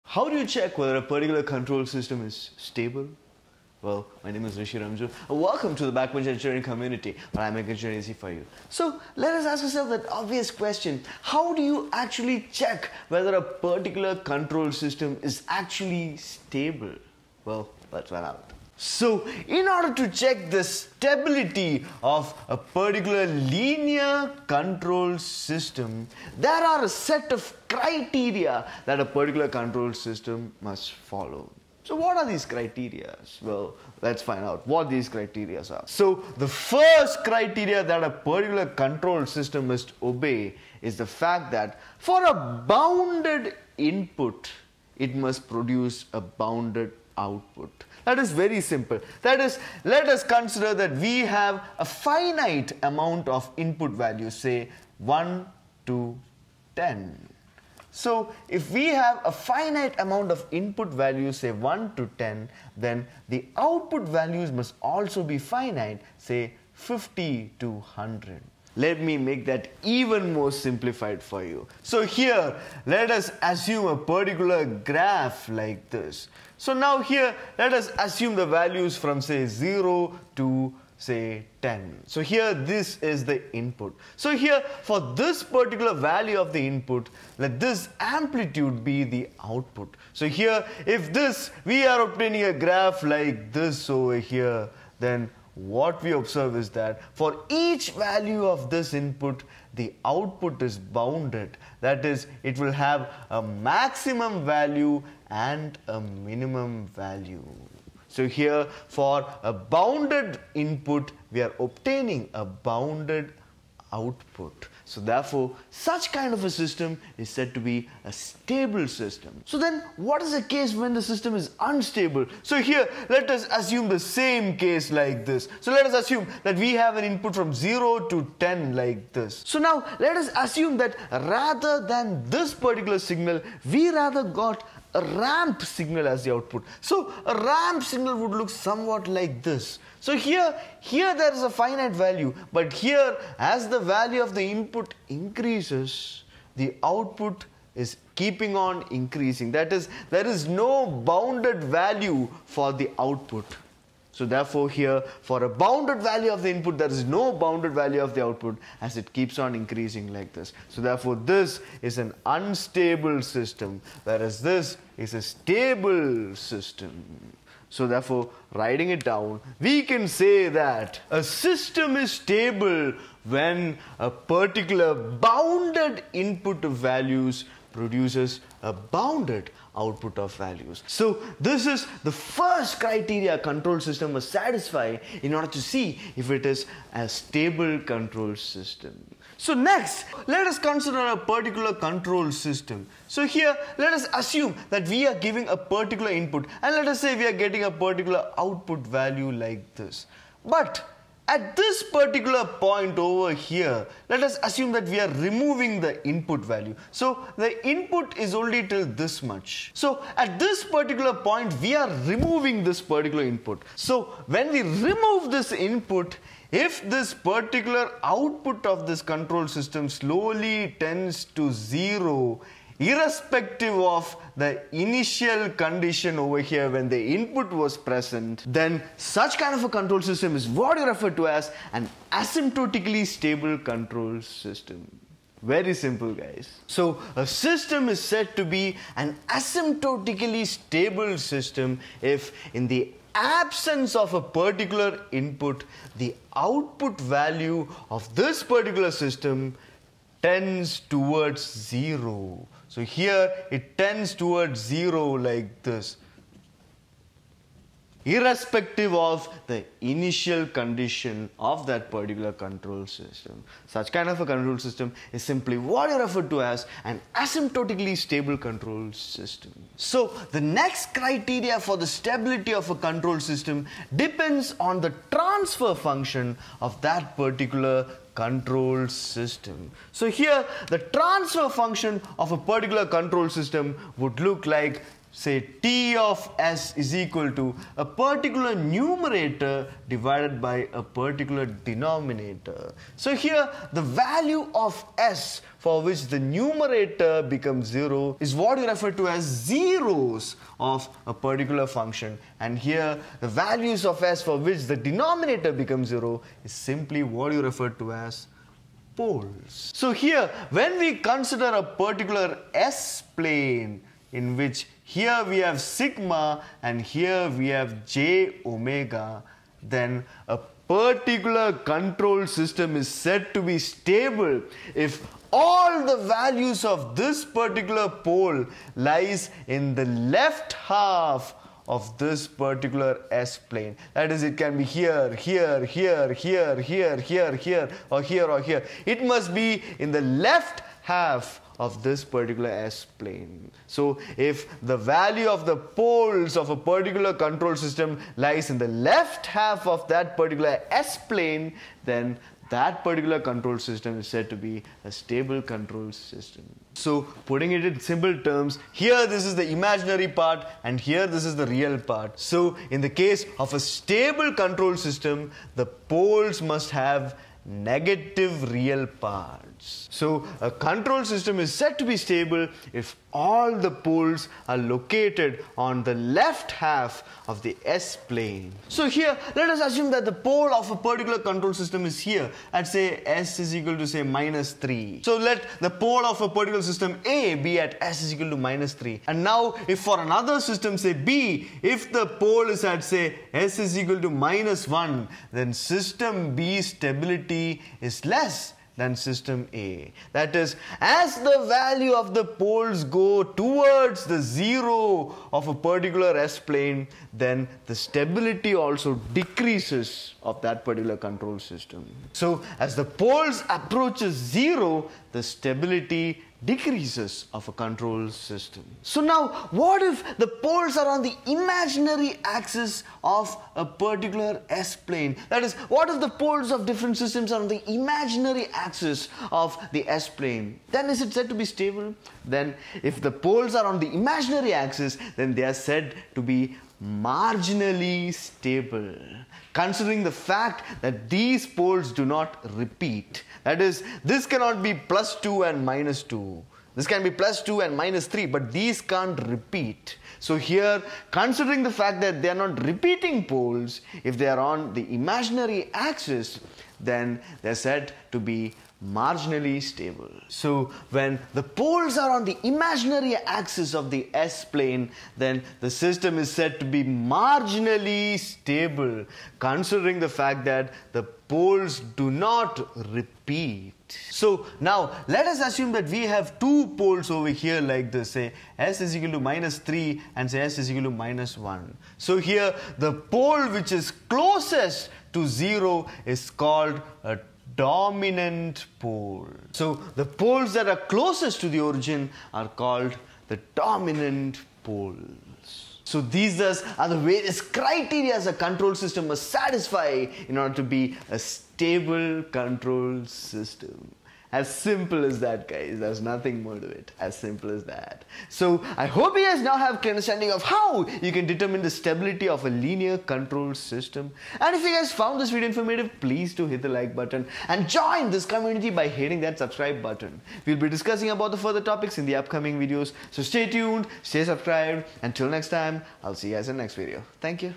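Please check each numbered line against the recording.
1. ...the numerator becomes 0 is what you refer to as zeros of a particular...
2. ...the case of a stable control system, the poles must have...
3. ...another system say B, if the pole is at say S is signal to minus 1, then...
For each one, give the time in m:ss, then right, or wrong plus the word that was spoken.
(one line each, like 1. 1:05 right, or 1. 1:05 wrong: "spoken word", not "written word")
1. 4:56 right
2. 6:02 right
3. 6:29 wrong: "equal", not "signal".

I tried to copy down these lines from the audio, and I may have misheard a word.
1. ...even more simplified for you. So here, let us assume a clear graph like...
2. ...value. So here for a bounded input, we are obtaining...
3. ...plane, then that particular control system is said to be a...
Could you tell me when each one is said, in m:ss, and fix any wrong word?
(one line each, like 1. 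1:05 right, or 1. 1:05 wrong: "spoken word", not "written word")
1. 1:09 wrong: "particular", not "clear"
2. 1:46 right
3. 5:50 right.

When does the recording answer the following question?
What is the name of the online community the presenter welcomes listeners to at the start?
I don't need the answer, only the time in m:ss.
0:05.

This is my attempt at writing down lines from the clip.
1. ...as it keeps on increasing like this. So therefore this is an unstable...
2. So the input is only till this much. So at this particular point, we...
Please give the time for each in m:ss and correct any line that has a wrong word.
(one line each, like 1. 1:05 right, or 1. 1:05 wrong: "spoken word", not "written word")
1. 2:38 right
2. 3:26 right.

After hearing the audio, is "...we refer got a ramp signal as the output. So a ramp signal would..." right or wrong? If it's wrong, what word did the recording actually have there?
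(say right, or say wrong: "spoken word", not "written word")
wrong: "rather", not "refer".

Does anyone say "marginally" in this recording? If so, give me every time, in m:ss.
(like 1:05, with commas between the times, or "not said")
7:16, 7:38, 7:46.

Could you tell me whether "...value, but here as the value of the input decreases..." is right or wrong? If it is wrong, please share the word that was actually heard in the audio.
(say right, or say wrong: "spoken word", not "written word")
wrong: "increases", not "decreases".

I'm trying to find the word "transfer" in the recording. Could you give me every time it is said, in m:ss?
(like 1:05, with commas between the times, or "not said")
4:35, 4:40.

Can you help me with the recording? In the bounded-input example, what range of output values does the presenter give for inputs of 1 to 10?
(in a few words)
50 to 100.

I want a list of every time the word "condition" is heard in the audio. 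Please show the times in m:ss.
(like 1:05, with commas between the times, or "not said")
3:45, 4:20.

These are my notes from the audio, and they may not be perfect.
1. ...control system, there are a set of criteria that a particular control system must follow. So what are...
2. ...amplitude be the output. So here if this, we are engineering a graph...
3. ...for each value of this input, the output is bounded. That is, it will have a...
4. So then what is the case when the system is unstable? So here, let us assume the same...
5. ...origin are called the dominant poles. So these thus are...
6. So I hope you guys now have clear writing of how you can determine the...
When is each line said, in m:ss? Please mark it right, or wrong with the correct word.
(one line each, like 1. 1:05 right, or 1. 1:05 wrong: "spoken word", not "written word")
1. 0:24 right
2. 1:27 wrong: "obtaining", not "engineering"
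3. 1:37 right
4. 1:59 right
5. 8:11 right
6. 8:28 wrong: "understanding", not "writing".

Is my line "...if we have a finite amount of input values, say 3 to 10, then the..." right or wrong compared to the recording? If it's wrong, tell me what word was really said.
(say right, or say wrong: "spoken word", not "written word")
wrong: "1", not "3".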